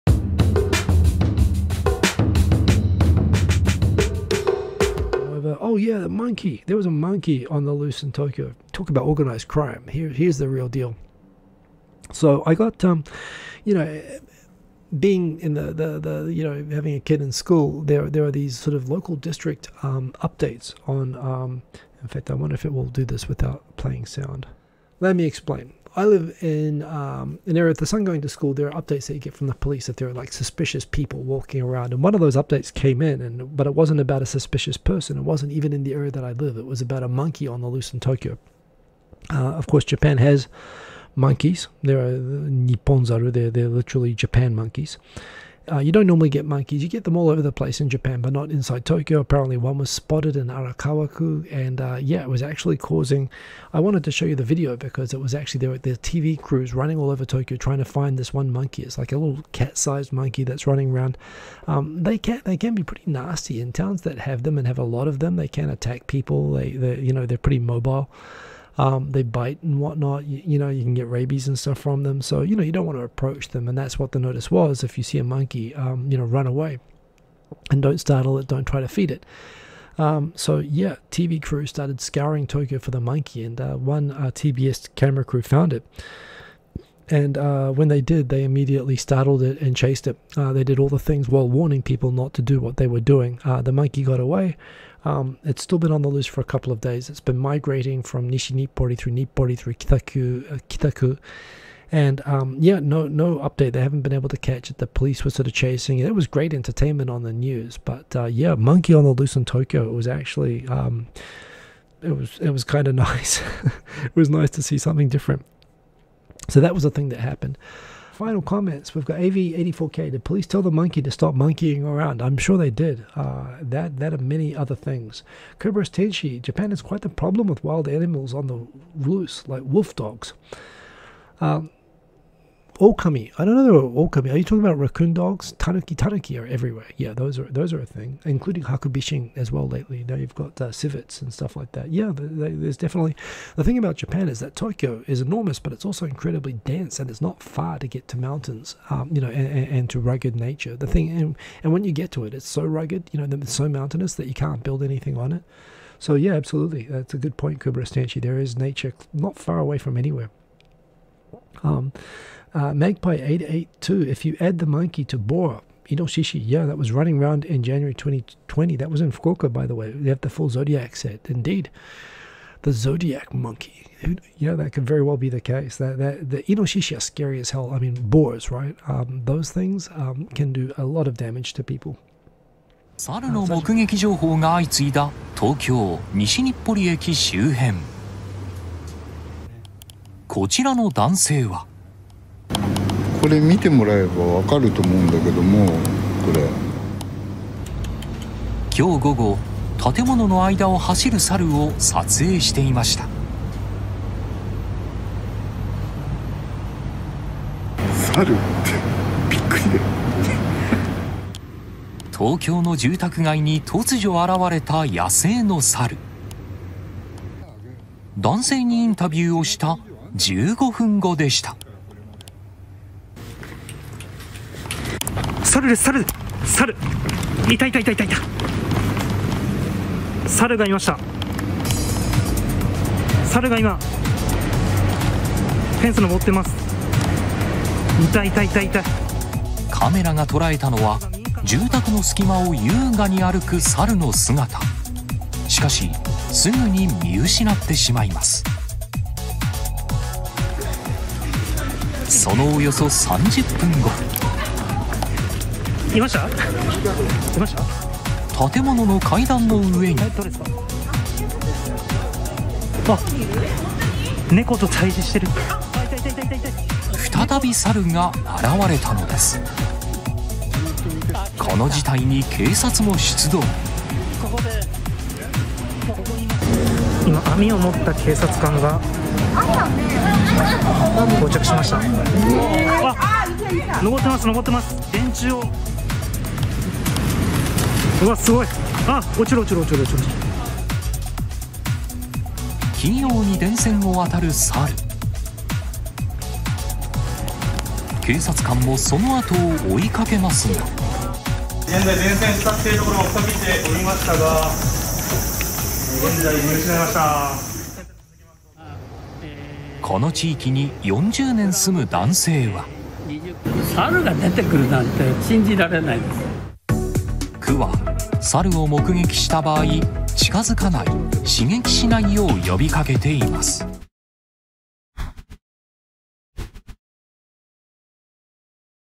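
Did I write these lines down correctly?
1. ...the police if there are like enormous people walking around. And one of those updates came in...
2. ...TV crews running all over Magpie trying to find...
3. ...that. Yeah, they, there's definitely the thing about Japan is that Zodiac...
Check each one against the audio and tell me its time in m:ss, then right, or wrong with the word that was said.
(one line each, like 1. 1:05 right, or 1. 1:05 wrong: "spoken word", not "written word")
1. 0:29 wrong: "suspicious", not "enormous"
2. 0:55 wrong: "Tokyo", not "Magpie"
3. 2:21 wrong: "Tokyo", not "Zodiac".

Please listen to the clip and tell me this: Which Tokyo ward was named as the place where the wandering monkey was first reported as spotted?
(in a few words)
Arakawa-ku.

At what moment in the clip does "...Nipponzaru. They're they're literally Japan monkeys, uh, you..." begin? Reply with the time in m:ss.
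0:42.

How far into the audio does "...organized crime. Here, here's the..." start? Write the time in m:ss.
0:09.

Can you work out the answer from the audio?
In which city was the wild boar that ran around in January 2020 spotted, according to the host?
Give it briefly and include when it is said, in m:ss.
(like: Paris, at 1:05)
Fukuoka, at 2:49.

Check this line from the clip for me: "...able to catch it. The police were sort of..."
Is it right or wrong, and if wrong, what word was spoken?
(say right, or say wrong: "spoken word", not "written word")
right.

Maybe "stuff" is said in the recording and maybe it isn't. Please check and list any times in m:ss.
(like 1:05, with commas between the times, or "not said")
1:11, 2:21.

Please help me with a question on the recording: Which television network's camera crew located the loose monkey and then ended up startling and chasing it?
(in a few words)
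TBS.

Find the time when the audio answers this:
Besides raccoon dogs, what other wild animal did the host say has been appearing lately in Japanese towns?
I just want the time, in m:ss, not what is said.
2:18.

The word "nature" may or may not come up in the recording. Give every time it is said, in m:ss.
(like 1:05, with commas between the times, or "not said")
2:30, 2:38.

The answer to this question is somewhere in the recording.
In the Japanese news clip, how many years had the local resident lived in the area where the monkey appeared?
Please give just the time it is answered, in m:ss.
5:10.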